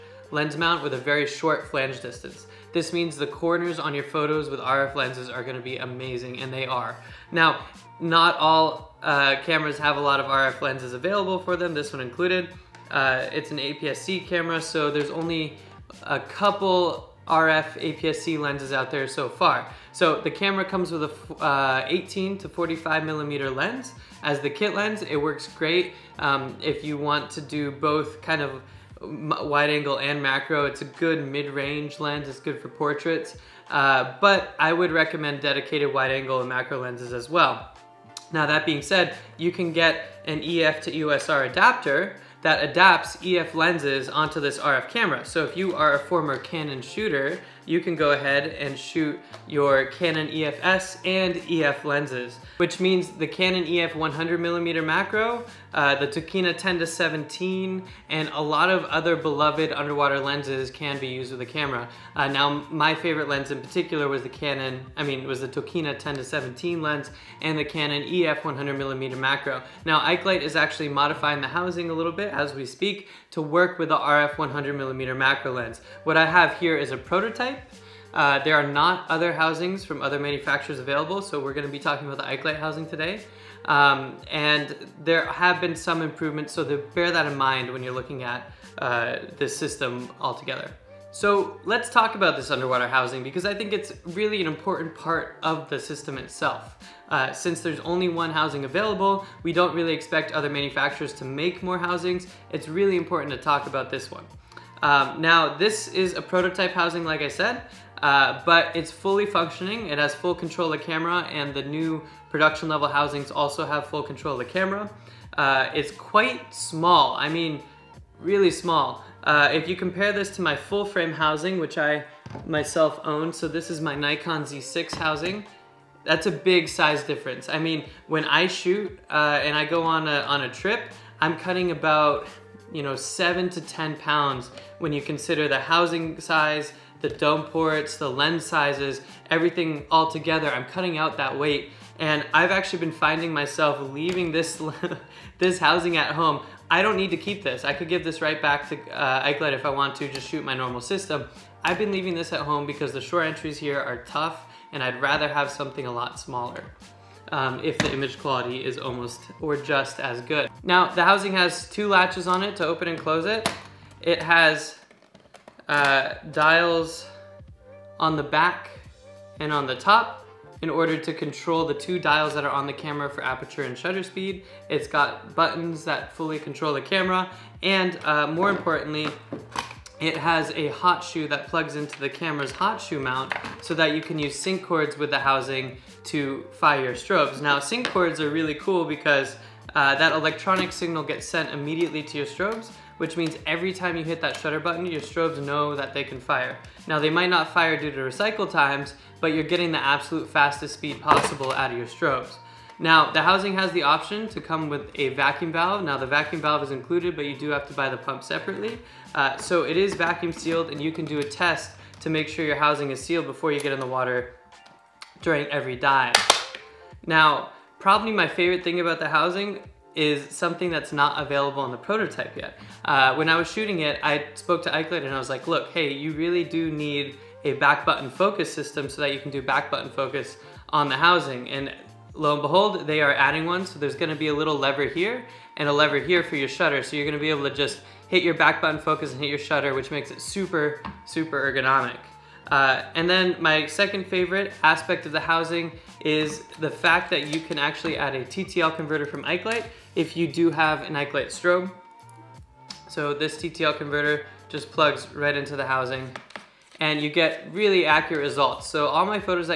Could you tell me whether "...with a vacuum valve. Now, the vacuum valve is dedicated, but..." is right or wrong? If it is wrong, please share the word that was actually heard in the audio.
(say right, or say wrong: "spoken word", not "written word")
wrong: "included", not "dedicated".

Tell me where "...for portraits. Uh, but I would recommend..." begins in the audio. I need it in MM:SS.
00:32.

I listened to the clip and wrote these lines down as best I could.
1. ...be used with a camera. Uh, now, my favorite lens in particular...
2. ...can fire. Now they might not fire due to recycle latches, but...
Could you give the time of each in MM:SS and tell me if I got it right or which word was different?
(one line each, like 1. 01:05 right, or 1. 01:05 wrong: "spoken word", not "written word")
1. 01:00 right
2. 03:16 wrong: "times", not "latches".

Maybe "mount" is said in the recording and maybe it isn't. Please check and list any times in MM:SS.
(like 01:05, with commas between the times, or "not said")
00:00, 03:02.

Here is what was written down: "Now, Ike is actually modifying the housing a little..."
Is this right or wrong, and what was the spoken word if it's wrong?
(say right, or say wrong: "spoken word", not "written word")
right.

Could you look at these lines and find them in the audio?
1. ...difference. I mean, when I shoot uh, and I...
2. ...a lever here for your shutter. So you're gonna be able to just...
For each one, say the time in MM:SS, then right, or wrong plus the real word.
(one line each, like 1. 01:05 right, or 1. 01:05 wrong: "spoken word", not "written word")
1. 02:07 right
2. 03:55 right.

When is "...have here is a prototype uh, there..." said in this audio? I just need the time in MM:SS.
01:16.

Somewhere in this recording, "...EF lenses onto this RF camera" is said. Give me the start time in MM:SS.
00:43.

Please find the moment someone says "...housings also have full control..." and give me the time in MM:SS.
01:52.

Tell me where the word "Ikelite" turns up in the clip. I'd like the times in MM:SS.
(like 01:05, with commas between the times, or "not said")
02:29, 03:44.